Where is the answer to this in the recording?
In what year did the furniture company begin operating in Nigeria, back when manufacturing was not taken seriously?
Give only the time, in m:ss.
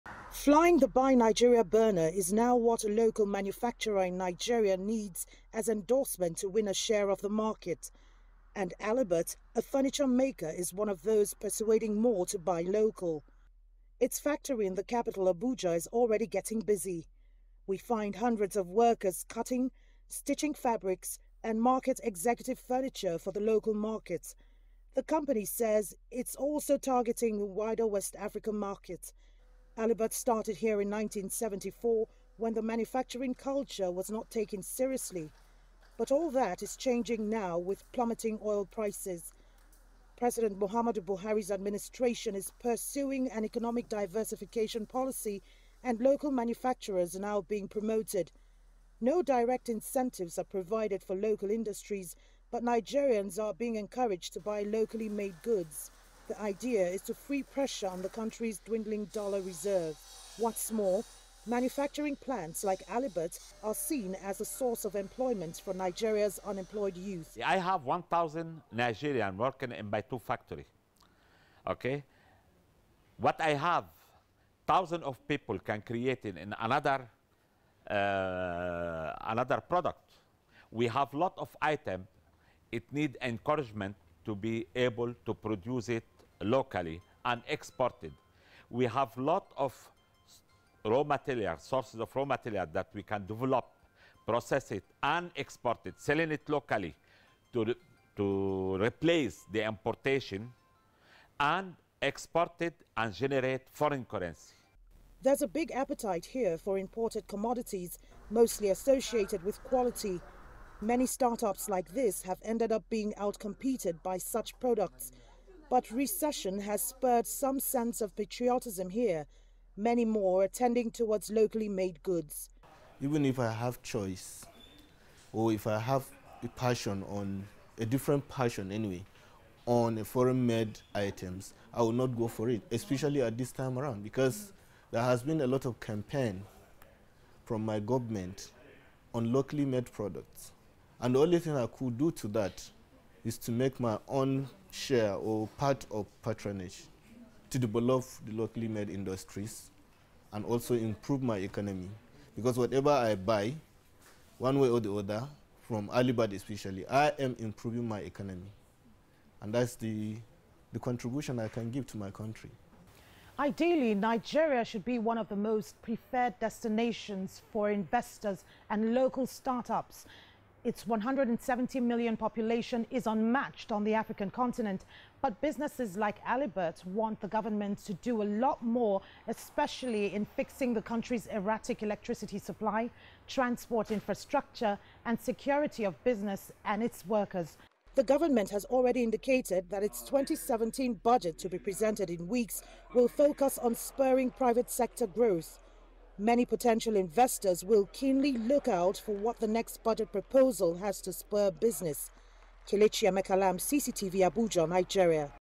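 0:30.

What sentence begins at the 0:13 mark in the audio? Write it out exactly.
Its factory in the capital Abuja is already getting busy.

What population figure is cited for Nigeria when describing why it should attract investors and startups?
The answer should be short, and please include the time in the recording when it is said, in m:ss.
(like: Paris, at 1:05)
170 million, at 2:50.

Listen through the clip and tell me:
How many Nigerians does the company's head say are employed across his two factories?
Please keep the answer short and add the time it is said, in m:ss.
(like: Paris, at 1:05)
1,000, at 1:07.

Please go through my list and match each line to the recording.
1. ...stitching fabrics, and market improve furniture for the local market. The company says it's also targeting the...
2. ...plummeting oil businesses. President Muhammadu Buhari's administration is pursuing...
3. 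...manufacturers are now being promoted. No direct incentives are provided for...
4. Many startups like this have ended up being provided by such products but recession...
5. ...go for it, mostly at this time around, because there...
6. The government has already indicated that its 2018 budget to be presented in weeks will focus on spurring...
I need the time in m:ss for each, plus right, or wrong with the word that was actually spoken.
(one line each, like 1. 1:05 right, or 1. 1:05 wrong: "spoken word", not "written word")
1. 0:20 wrong: "executive", not "improve"
2. 0:37 wrong: "prices", not "businesses"
3. 0:46 right
4. 1:50 wrong: "outcompeted", not "provided"
5. 2:12 wrong: "especially", not "mostly"
6. 3:07 wrong: "2017", not "2018".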